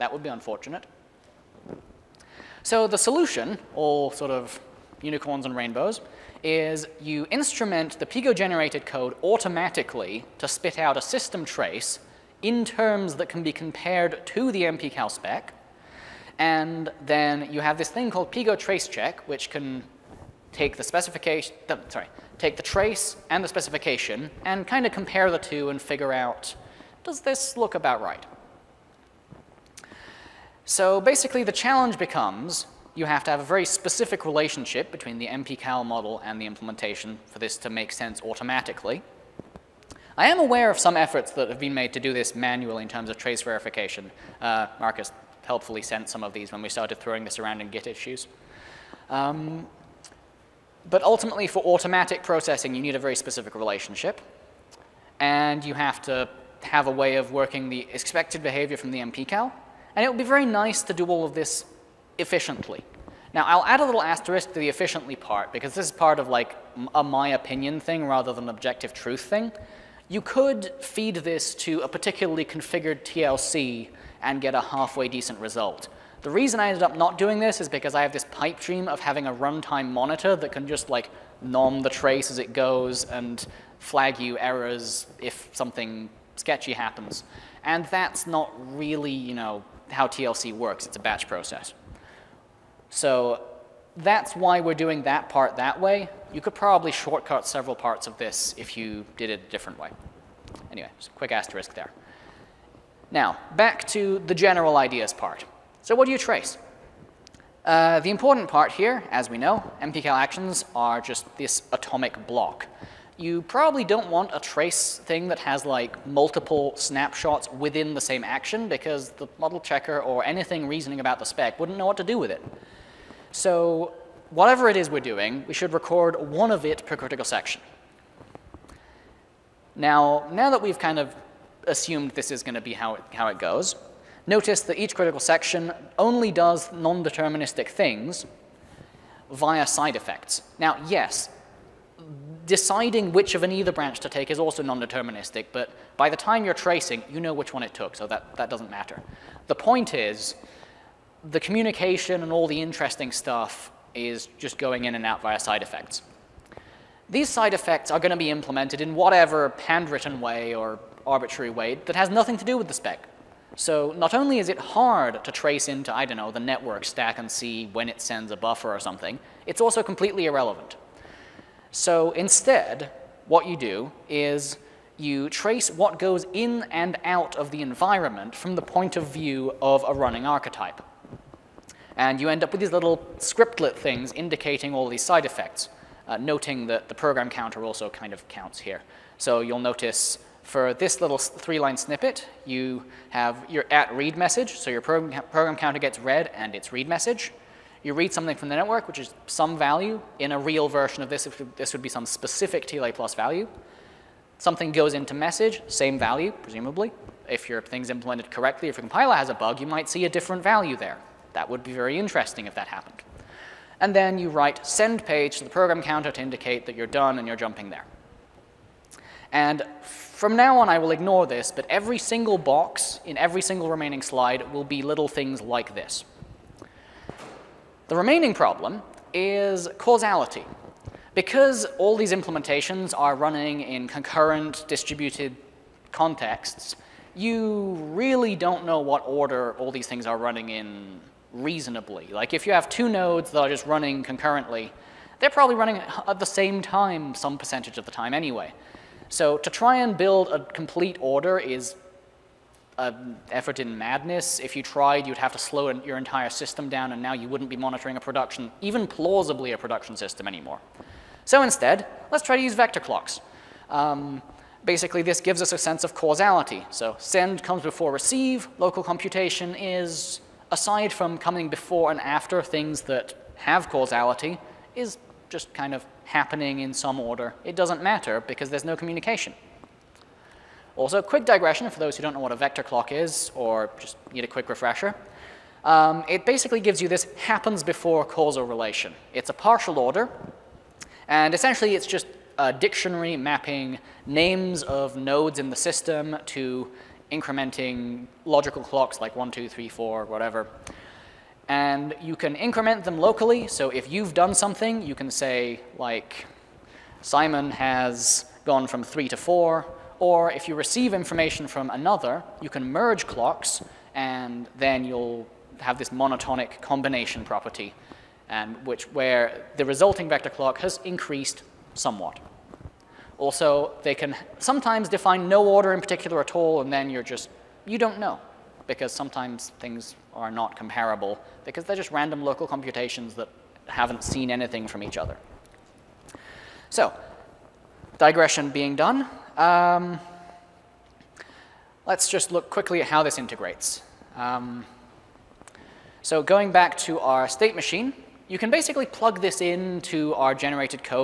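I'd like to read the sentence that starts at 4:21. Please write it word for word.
So instead, let's try to use vector clocks.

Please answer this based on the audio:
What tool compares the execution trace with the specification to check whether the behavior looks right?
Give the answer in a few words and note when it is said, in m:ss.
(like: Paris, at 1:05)
PGo trace check, at 0:18.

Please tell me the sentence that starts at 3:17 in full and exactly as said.
You read something from the network, which is some value.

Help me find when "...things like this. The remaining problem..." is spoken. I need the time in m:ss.
3:45.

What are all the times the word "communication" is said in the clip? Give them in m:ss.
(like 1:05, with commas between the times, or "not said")
2:31, 4:38.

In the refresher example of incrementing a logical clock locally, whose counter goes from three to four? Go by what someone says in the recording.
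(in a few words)
Simon.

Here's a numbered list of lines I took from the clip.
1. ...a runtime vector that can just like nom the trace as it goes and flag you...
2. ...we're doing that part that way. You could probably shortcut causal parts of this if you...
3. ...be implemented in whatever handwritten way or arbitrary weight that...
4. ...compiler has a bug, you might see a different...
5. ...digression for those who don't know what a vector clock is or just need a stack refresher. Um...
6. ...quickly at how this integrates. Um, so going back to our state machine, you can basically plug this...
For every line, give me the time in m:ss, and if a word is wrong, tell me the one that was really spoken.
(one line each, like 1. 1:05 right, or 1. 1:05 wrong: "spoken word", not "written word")
1. 1:19 wrong: "monitor", not "vector"
2. 1:34 wrong: "several", not "causal"
3. 2:38 right
4. 3:28 right
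5. 4:41 wrong: "quick", not "stack"
6. 5:42 right.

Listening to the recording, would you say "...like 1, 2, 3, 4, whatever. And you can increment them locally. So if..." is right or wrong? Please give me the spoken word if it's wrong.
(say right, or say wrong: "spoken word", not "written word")
right.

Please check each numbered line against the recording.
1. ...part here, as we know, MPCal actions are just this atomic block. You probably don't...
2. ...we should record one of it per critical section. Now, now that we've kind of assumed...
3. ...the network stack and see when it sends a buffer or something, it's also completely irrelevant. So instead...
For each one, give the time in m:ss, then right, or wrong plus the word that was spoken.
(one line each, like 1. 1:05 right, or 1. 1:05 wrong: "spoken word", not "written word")
1. 1:48 right
2. 2:05 right
3. 2:46 right.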